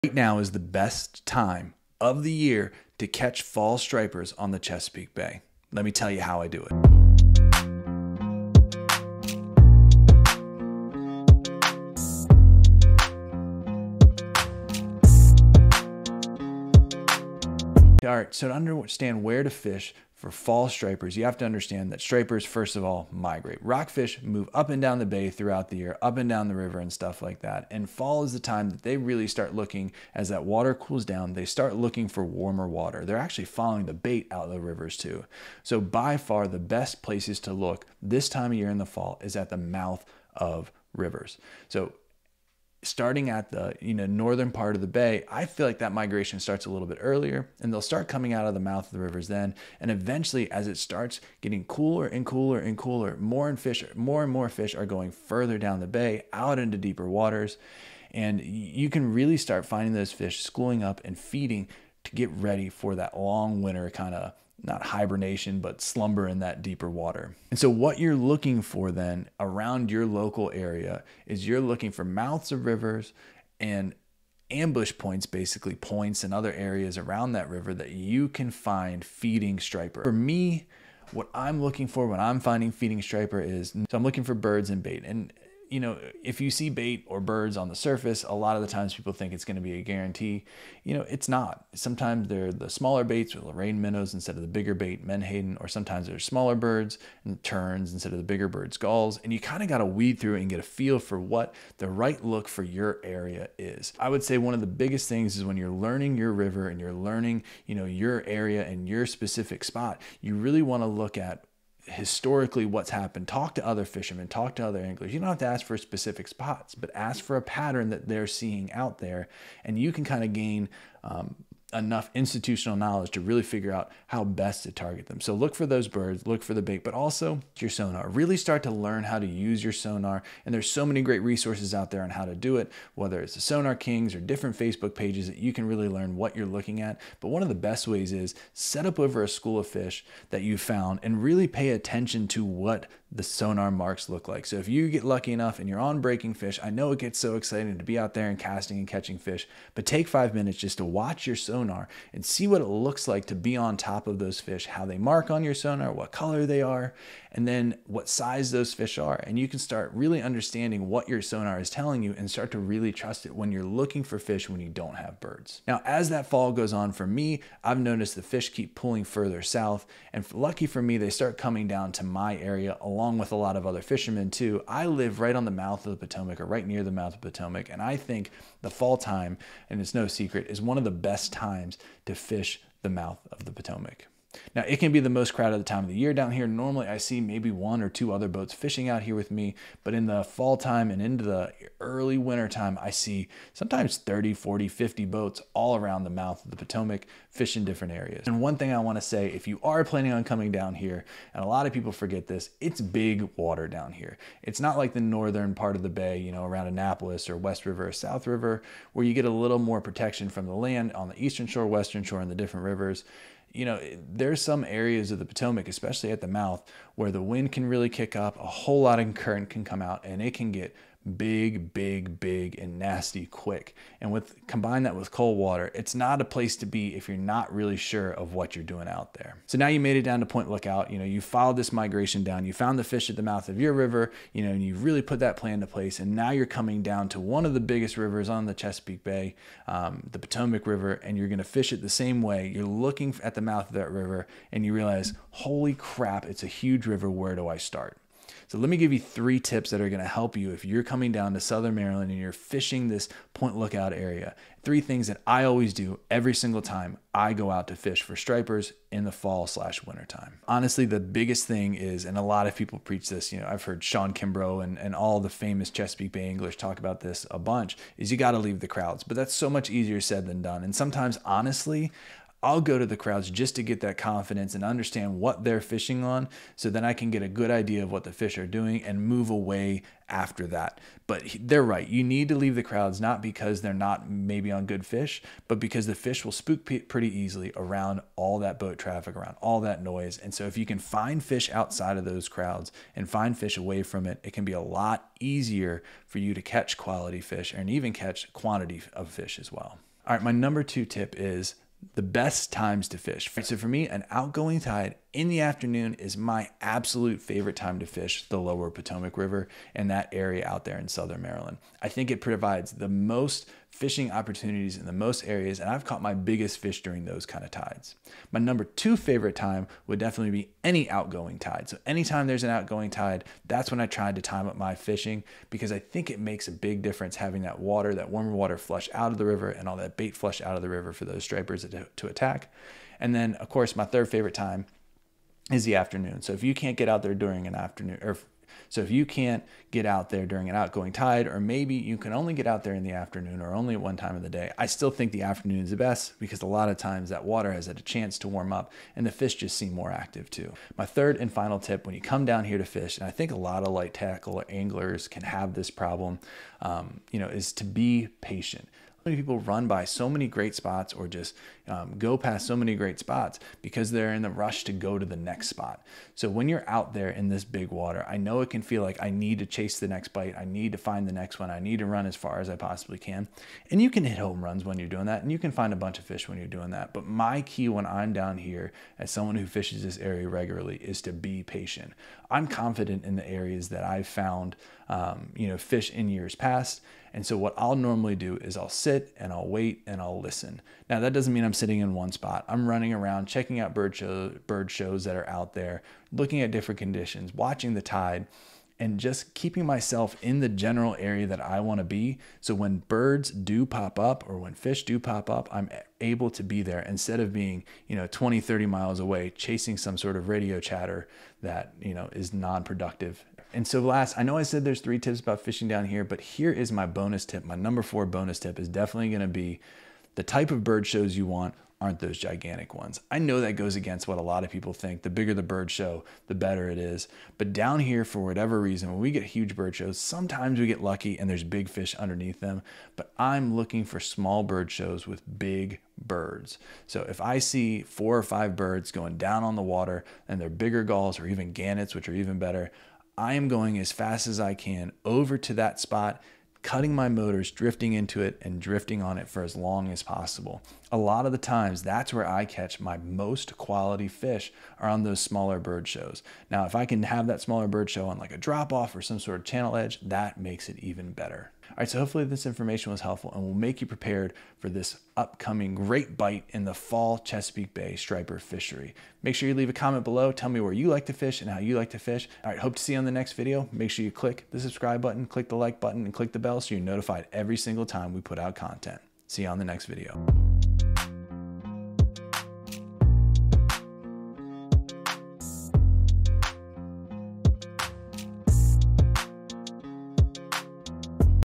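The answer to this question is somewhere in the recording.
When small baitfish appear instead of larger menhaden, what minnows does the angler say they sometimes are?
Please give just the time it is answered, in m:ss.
1:33.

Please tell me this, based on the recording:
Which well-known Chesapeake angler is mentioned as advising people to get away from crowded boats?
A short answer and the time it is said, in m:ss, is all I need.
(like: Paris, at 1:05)
Shawn Kimbro, at 4:23.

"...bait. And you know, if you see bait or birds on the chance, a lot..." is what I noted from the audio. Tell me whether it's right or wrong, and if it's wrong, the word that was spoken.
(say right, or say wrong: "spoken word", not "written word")
wrong: "surface", not "chance".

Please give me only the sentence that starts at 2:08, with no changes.
Really start to learn how to use your sonar.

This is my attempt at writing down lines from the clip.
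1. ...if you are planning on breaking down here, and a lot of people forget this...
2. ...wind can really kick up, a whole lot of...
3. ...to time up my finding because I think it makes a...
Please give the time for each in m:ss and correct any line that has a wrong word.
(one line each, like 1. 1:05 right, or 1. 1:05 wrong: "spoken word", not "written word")
1. 3:19 wrong: "coming", not "breaking"
2. 3:37 right
3. 5:24 wrong: "fishing", not "finding".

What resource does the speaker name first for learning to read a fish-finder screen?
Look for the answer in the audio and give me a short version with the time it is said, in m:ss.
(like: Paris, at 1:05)
Sonar Kings, at 2:13.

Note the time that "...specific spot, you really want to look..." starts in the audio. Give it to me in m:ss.
1:49.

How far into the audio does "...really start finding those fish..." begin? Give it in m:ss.
0:59.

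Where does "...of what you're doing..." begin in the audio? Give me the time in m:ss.
3:48.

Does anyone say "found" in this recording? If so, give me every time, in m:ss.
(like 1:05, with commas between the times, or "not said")
2:20, 3:52, 6:24.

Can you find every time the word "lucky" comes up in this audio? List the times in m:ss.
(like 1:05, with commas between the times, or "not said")
2:25, 2:50, 7:10.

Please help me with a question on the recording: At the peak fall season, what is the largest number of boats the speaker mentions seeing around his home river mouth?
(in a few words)
50.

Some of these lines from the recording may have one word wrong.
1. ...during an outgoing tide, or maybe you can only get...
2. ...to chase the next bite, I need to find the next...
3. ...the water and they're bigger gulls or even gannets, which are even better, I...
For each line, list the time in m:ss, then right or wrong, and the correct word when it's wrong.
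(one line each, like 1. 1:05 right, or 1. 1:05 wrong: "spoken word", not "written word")
1. 5:40 right
2. 6:09 right
3. 7:19 right.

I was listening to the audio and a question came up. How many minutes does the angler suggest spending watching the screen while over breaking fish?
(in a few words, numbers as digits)
5.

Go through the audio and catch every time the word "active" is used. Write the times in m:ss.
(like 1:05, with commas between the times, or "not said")
5:49.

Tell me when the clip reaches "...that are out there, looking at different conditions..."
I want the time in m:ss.
6:35.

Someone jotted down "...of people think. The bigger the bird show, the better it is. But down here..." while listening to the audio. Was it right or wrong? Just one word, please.
right.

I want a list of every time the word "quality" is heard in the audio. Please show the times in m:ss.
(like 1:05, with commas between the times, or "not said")
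4:56, 7:33.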